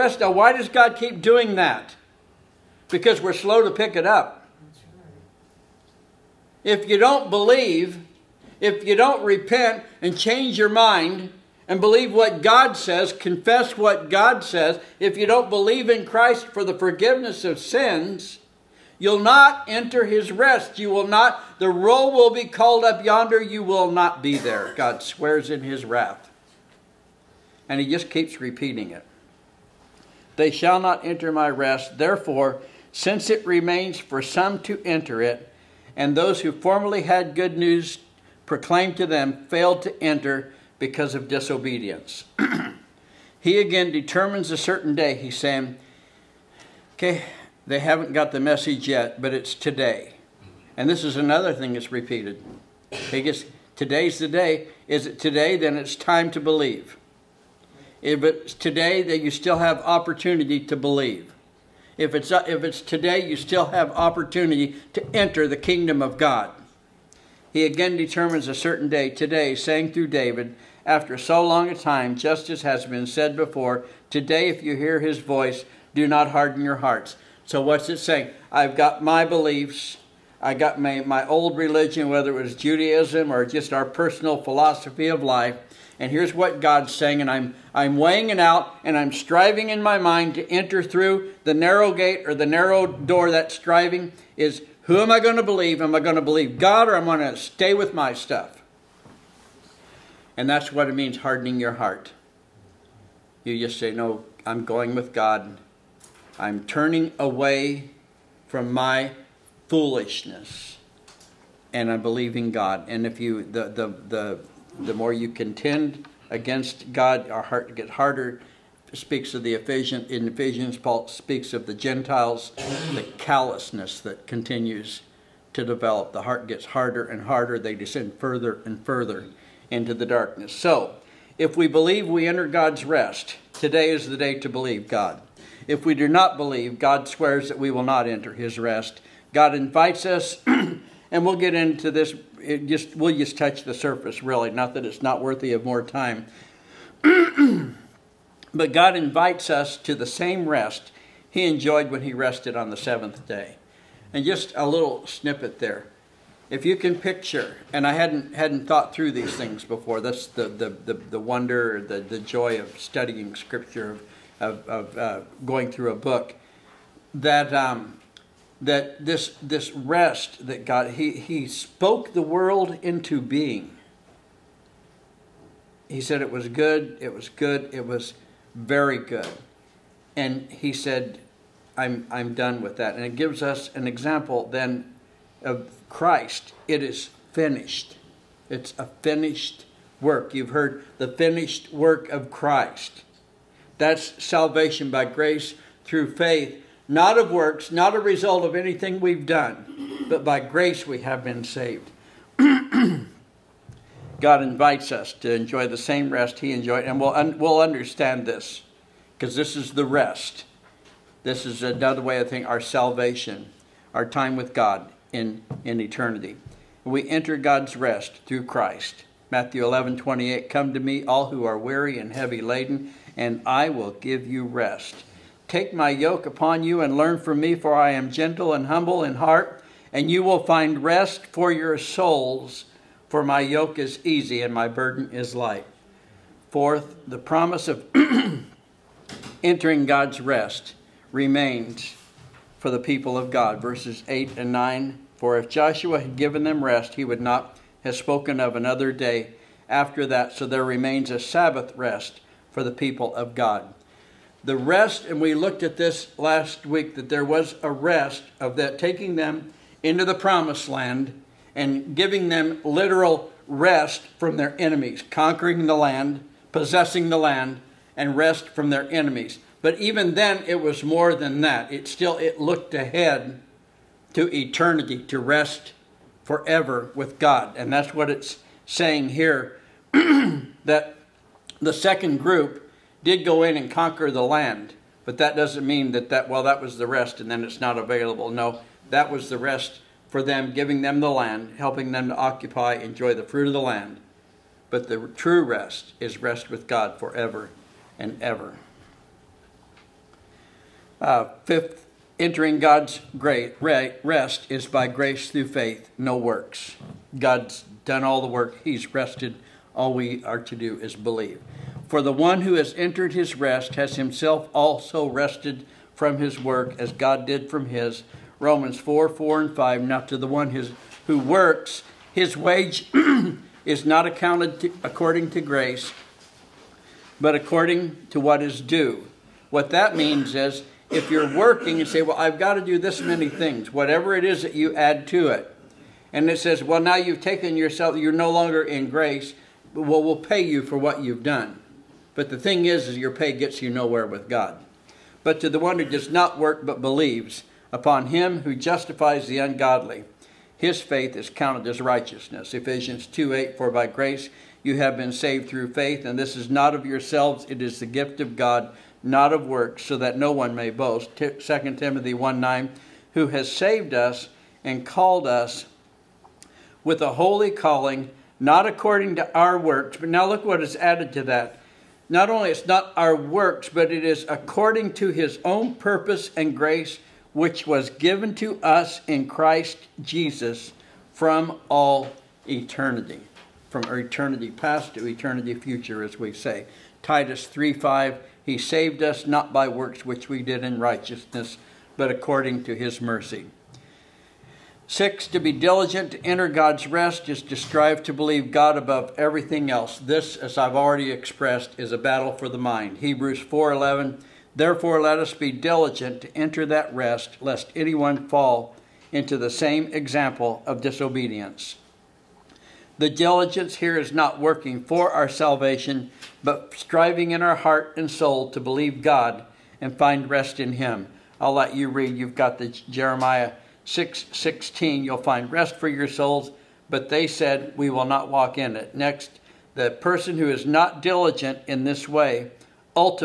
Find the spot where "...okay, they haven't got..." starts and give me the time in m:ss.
0:46.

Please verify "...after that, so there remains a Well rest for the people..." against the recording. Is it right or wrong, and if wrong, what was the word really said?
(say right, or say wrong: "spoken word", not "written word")
wrong: "Sabbath", not "Well".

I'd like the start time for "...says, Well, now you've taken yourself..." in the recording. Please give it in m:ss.
5:36.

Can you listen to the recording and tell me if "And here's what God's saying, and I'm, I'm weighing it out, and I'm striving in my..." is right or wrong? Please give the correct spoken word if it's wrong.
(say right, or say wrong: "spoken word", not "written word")
right.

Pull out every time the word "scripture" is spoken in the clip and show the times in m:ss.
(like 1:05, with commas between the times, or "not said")
2:43.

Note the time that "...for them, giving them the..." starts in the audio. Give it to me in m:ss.
4:50.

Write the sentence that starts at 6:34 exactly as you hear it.
Six, to be diligent to enter God's rest is to strive to believe God above everything else.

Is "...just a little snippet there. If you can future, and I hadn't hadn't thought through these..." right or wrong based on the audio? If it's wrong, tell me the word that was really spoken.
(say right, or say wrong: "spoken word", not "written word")
wrong: "picture", not "future".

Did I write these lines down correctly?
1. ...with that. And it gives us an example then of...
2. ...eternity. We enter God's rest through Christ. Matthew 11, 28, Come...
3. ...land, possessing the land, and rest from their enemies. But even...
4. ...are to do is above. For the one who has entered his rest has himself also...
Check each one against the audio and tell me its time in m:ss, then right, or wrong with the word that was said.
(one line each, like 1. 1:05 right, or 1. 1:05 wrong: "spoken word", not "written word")
1. 3:02 right
2. 3:35 right
3. 4:25 right
4. 5:10 wrong: "believe", not "above".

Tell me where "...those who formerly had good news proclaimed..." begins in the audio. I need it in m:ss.
0:36.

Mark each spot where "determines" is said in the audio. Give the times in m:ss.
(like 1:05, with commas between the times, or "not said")
0:43, 1:07.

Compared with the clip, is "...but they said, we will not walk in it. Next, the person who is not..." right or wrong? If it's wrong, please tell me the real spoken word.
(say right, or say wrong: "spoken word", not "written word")
right.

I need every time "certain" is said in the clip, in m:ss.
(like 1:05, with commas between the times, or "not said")
0:44, 1:08.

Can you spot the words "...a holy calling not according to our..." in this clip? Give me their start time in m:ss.
6:07.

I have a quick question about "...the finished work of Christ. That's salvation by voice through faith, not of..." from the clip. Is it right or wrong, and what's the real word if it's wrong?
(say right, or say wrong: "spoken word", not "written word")
wrong: "grace", not "voice".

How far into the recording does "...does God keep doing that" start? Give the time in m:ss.
0:00.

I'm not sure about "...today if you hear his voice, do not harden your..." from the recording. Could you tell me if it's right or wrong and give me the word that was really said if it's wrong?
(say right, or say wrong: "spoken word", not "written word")
right.